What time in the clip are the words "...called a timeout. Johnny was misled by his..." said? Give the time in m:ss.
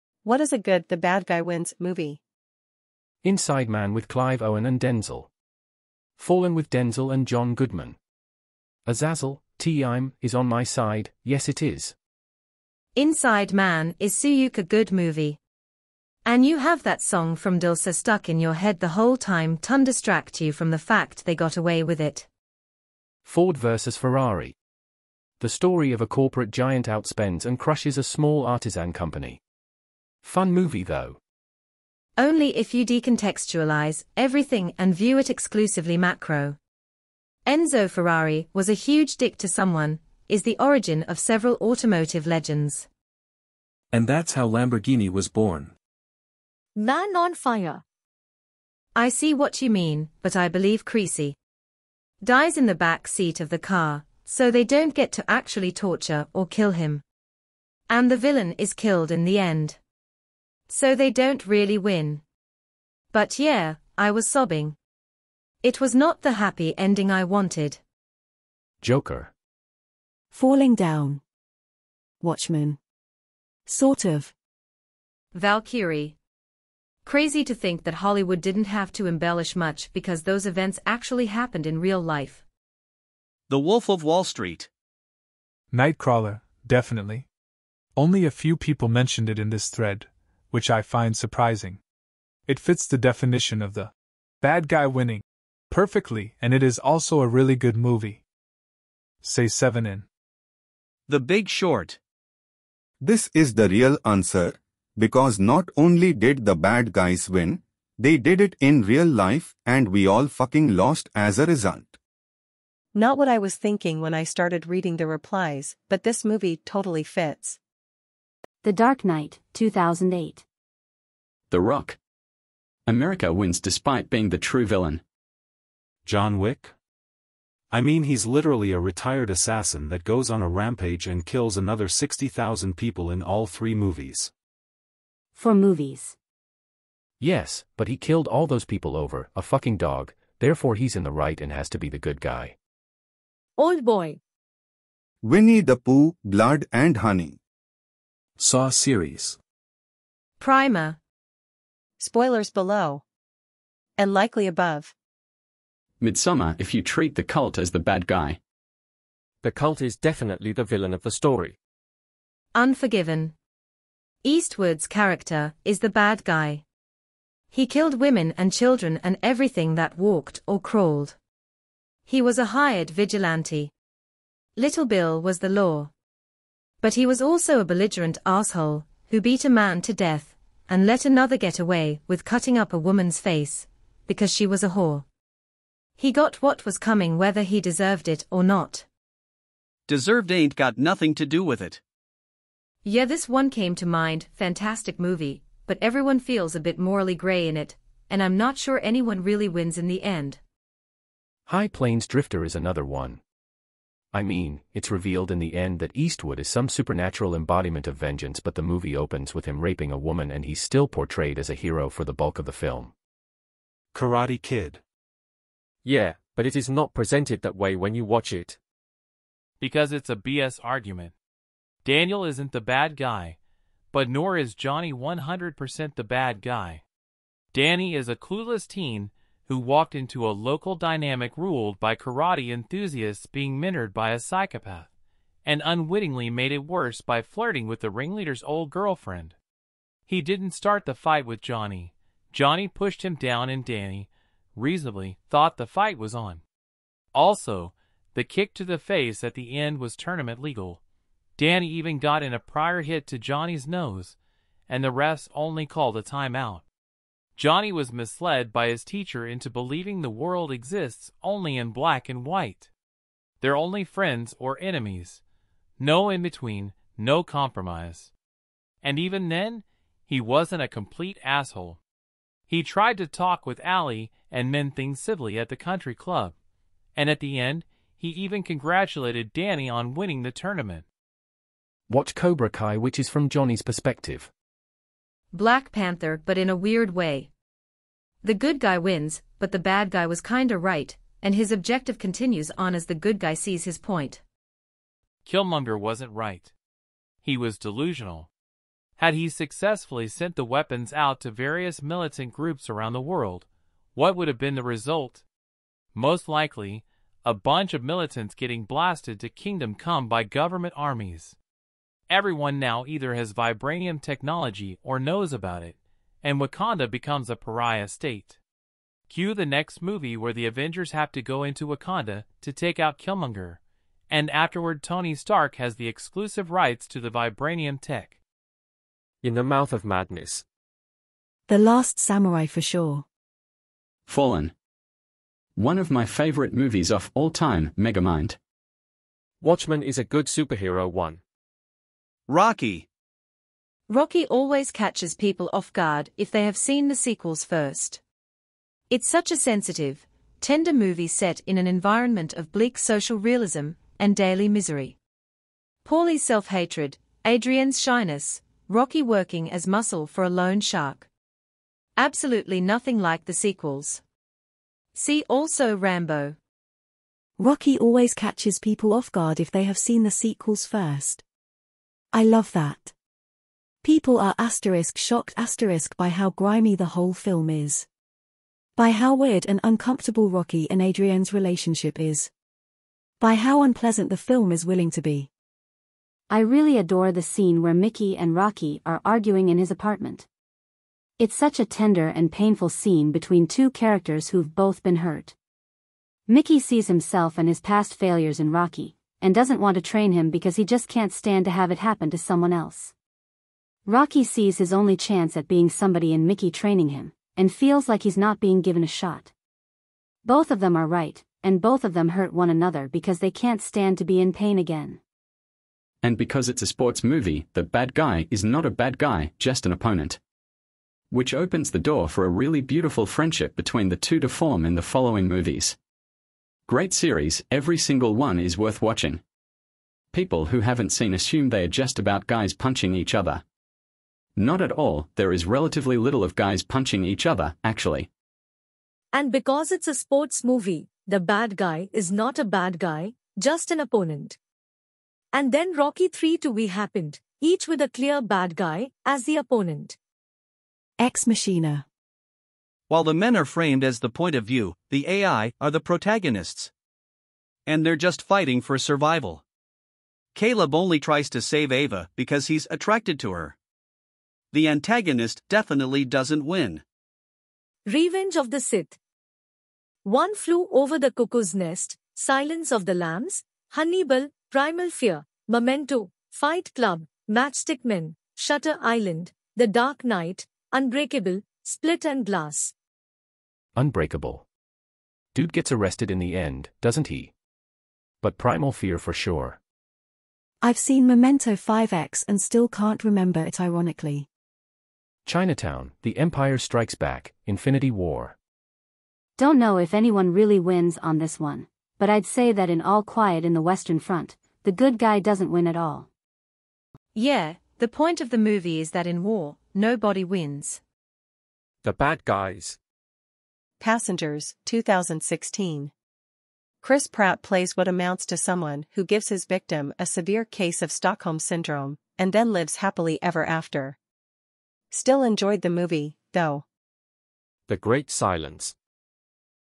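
4:15.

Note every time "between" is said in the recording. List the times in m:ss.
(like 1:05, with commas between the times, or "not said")
4:26, 6:33, 7:03.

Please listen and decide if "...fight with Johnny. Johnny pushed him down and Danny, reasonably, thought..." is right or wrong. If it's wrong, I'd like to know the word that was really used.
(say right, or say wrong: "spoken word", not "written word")
right.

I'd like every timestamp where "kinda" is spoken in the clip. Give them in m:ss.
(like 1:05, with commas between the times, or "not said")
4:50.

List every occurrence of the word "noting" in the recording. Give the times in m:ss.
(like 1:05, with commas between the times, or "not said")
not said.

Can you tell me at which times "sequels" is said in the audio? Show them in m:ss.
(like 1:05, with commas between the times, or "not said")
5:46, 6:03, 6:10.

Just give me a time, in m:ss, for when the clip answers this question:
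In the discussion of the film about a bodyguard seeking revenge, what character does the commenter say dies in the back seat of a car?
0:50.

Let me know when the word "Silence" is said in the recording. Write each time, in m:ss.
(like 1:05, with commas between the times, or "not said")
7:52, 8:48.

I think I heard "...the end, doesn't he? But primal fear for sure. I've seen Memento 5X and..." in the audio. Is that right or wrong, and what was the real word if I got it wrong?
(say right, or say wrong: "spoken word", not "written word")
right.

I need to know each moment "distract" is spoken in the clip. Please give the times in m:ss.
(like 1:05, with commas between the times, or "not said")
0:19.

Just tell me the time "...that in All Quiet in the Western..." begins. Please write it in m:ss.
8:22.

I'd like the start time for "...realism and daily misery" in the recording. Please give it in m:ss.
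5:53.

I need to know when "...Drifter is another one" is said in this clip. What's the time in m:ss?
3:22.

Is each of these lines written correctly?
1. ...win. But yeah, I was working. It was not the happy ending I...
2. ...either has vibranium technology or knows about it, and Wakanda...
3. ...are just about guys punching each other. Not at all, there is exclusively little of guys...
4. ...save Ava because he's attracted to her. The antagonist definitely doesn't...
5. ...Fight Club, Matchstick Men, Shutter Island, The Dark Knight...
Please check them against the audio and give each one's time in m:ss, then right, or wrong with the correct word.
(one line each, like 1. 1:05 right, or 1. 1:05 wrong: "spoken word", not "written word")
1. 1:01 wrong: "sobbing", not "working"
2. 5:12 right
3. 7:11 wrong: "relatively", not "exclusively"
4. 7:41 right
5. 7:56 right.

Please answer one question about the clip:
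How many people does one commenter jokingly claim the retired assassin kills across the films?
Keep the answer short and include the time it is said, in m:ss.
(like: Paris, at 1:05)
60,000, at 2:11.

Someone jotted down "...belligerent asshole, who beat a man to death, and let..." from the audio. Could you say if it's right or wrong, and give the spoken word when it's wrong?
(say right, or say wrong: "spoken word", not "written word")
right.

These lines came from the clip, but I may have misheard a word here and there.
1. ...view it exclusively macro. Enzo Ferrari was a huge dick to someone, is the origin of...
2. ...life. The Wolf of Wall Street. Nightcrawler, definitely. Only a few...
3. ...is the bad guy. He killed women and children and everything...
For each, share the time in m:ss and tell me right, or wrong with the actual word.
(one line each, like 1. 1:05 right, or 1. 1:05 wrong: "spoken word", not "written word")
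1. 0:34 right
2. 1:22 right
3. 2:45 right.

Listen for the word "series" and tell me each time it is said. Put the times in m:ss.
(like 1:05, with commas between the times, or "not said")
2:28, 7:06.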